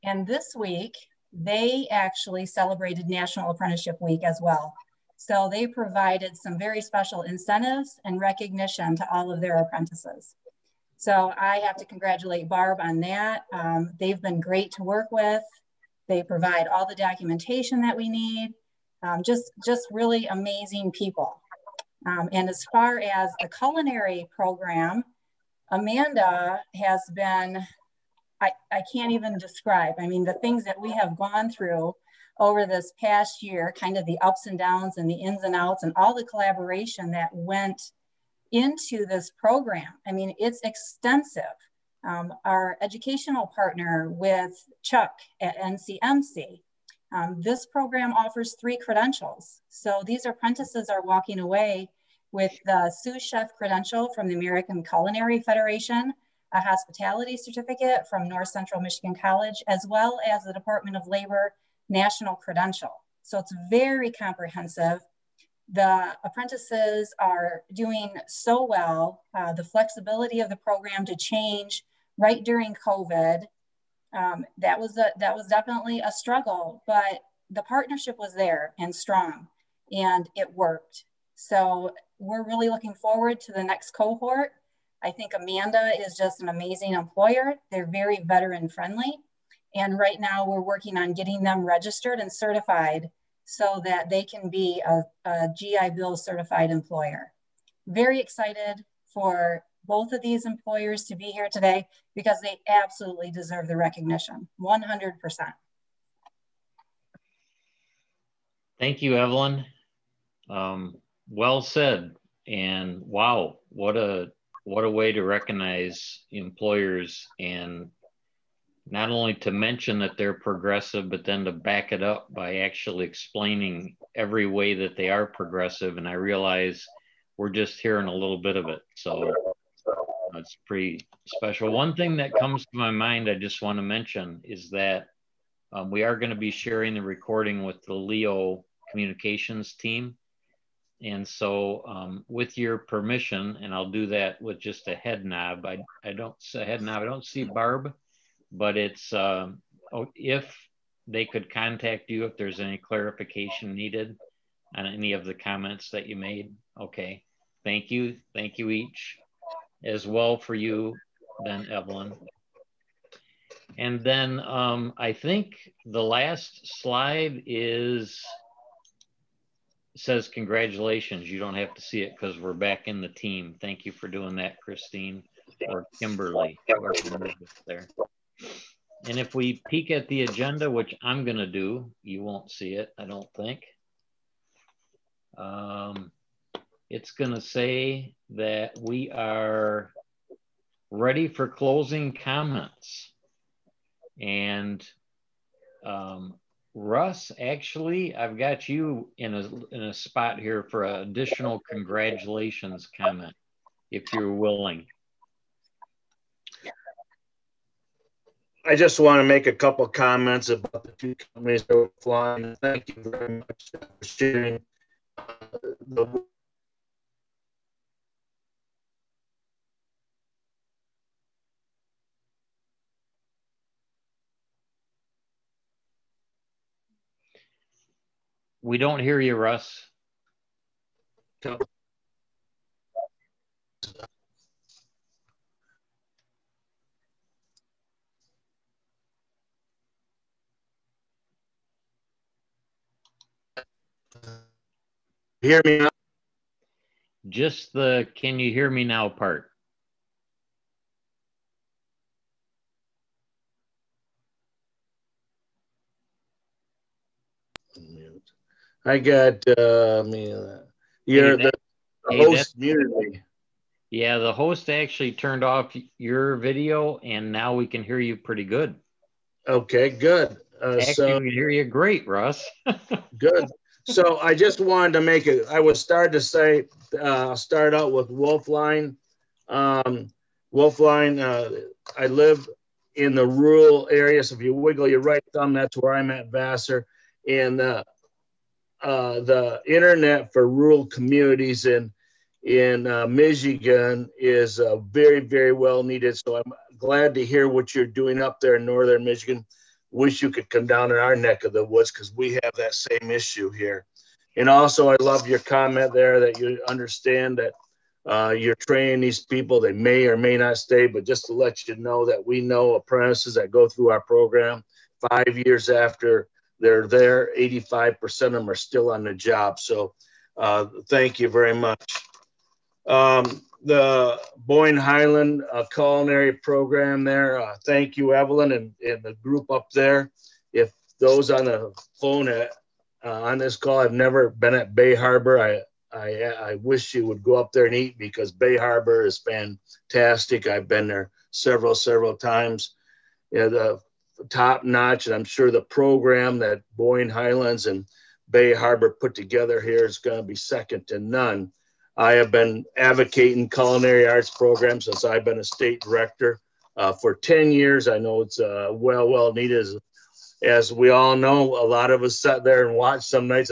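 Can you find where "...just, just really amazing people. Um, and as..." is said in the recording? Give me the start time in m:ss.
0:19.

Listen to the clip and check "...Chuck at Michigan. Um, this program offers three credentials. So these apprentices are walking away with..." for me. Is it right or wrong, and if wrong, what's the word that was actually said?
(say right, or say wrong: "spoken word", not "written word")
wrong: "NCMC", not "Michigan".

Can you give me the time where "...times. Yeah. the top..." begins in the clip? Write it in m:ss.
5:42.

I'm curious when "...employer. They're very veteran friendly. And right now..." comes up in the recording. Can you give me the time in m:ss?
1:26.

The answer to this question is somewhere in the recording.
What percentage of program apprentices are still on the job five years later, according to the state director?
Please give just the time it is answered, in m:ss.
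5:17.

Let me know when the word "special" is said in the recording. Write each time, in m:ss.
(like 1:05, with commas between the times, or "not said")
0:06, 2:11.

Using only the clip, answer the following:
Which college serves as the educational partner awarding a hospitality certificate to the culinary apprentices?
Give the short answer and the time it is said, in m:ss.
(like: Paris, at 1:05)
North Central Michigan College, at 0:58.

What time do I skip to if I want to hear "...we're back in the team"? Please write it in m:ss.
2:52.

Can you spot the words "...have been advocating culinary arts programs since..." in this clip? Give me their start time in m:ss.
5:52.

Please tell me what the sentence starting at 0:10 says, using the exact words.
So I have to congratulate Barb on that.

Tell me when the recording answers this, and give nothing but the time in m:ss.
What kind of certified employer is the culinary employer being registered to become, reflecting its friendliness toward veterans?
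1:35.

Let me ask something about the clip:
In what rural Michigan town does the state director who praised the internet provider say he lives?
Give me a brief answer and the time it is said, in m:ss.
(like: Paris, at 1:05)
Vassar, at 4:46.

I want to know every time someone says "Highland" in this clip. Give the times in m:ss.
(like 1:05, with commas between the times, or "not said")
5:24, 5:47.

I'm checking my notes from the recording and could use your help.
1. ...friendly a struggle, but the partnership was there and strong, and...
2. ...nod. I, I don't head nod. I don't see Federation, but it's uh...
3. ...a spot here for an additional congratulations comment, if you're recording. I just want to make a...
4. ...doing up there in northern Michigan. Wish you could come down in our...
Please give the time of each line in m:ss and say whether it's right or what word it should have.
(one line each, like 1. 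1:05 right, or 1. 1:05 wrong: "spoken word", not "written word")
1. 1:15 wrong: "definitely", not "friendly"
2. 2:25 wrong: "Barb", not "Federation"
3. 3:19 wrong: "willing", not "recording"
4. 4:57 right.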